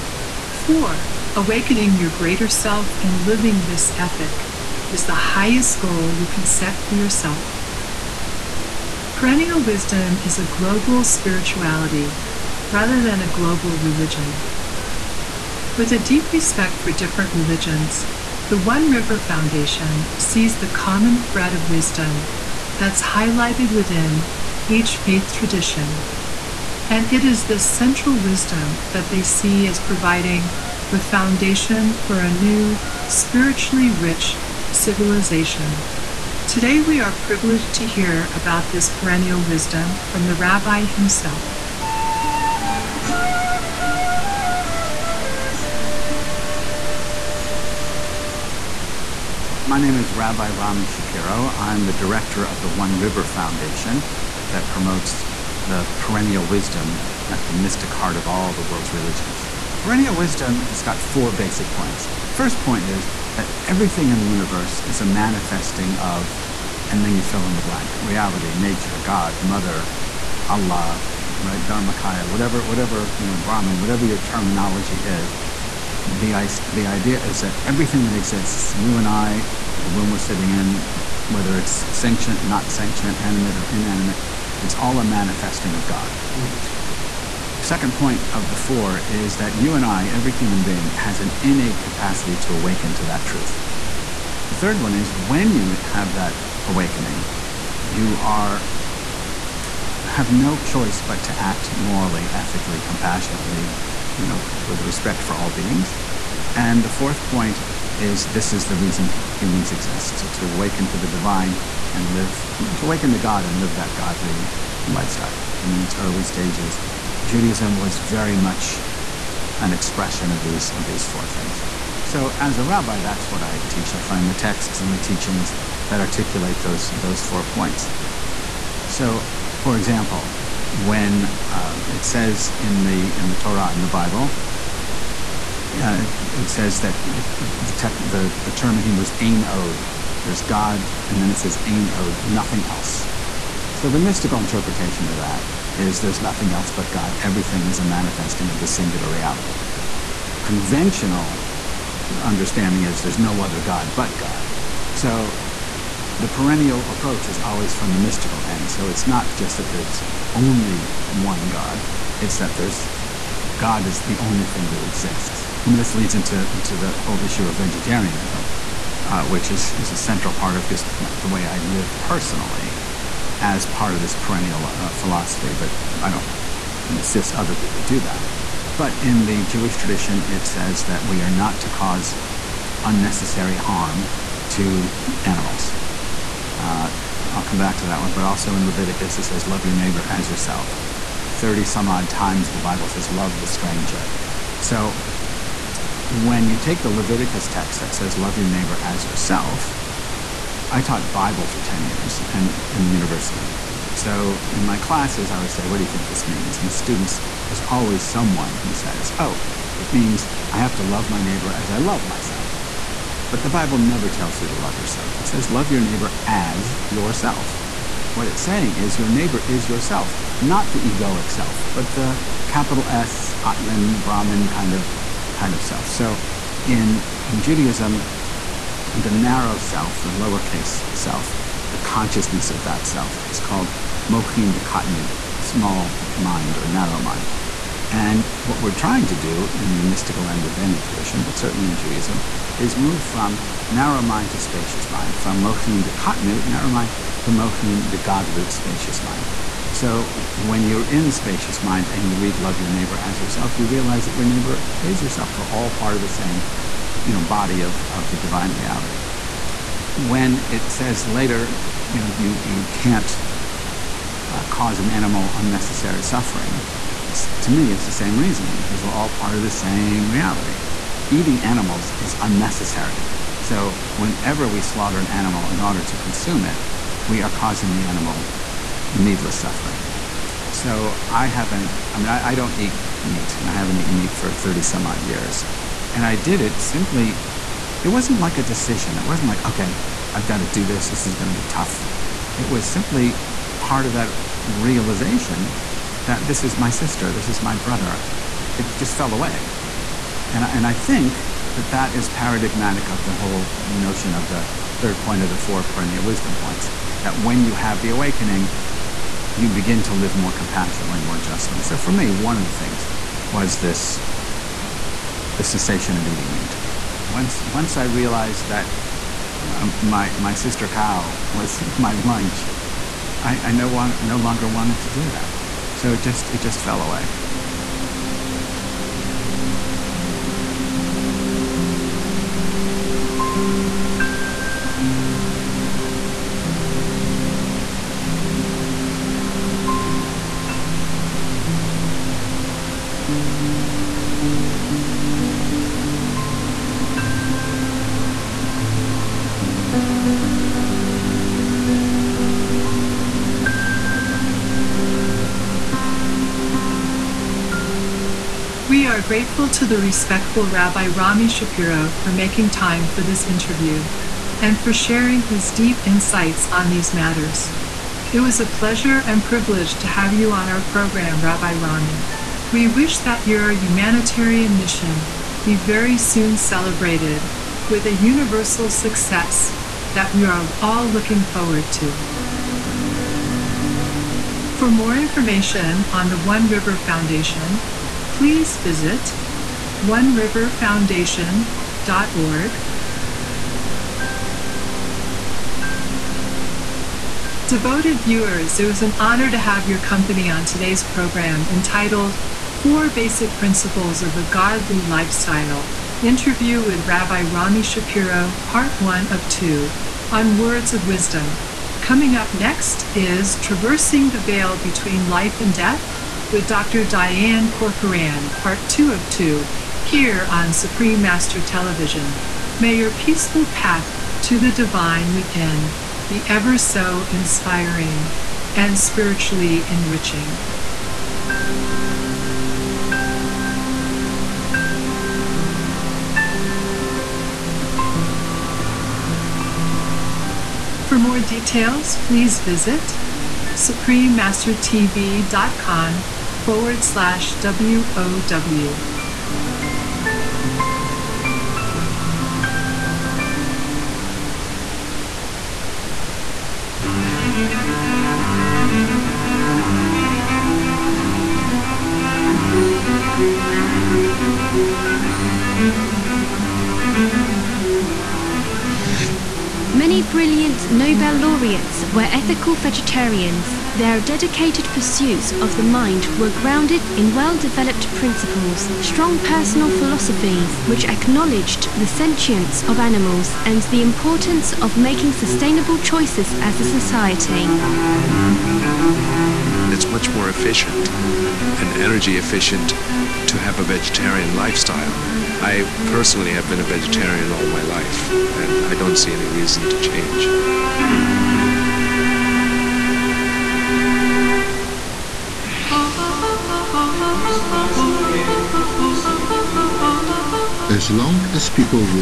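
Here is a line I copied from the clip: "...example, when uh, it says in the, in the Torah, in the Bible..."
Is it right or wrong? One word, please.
right.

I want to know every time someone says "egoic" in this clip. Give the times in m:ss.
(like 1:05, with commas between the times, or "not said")
3:40.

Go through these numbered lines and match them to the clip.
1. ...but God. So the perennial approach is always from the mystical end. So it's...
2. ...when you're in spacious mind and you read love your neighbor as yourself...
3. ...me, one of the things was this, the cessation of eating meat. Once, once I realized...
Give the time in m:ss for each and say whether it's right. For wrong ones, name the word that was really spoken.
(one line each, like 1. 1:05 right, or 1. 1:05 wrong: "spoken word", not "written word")
1. 2:33 right
2. 4:10 right
3. 5:11 right.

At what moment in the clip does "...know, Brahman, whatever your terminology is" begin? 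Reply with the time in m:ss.
1:13.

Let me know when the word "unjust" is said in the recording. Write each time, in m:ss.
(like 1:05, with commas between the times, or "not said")
not said.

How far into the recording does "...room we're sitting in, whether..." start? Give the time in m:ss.
1:19.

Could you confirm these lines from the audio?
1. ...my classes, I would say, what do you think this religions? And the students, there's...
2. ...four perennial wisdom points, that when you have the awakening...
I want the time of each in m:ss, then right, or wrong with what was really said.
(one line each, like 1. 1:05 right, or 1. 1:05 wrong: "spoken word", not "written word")
1. 3:24 wrong: "means", not "religions"
2. 5:05 right.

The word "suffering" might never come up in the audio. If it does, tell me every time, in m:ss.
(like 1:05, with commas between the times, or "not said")
4:26, 4:39.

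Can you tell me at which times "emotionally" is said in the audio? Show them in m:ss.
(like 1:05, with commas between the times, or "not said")
not said.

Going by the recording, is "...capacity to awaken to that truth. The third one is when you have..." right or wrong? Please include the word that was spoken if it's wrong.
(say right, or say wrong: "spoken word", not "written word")
right.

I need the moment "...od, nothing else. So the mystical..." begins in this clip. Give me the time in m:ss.
2:21.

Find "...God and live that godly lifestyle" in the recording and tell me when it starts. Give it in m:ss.
1:53.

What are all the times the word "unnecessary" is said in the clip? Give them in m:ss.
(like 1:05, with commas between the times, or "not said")
3:02, 4:25, 4:32.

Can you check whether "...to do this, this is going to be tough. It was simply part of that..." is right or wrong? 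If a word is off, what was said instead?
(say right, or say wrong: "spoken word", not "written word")
right.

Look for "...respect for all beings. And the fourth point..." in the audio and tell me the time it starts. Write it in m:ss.
1:44.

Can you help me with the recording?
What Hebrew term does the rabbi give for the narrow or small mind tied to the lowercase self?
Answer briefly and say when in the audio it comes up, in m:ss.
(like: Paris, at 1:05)
mochin de katnut, at 3:54.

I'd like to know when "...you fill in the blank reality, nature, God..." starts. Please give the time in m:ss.
1:07.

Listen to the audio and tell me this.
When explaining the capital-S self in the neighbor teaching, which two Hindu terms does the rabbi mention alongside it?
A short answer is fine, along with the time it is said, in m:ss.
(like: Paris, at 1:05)
Atman, Brahman, at 3:43.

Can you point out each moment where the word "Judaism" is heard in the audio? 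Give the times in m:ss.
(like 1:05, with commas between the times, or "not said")
1:57, 3:47, 4:01.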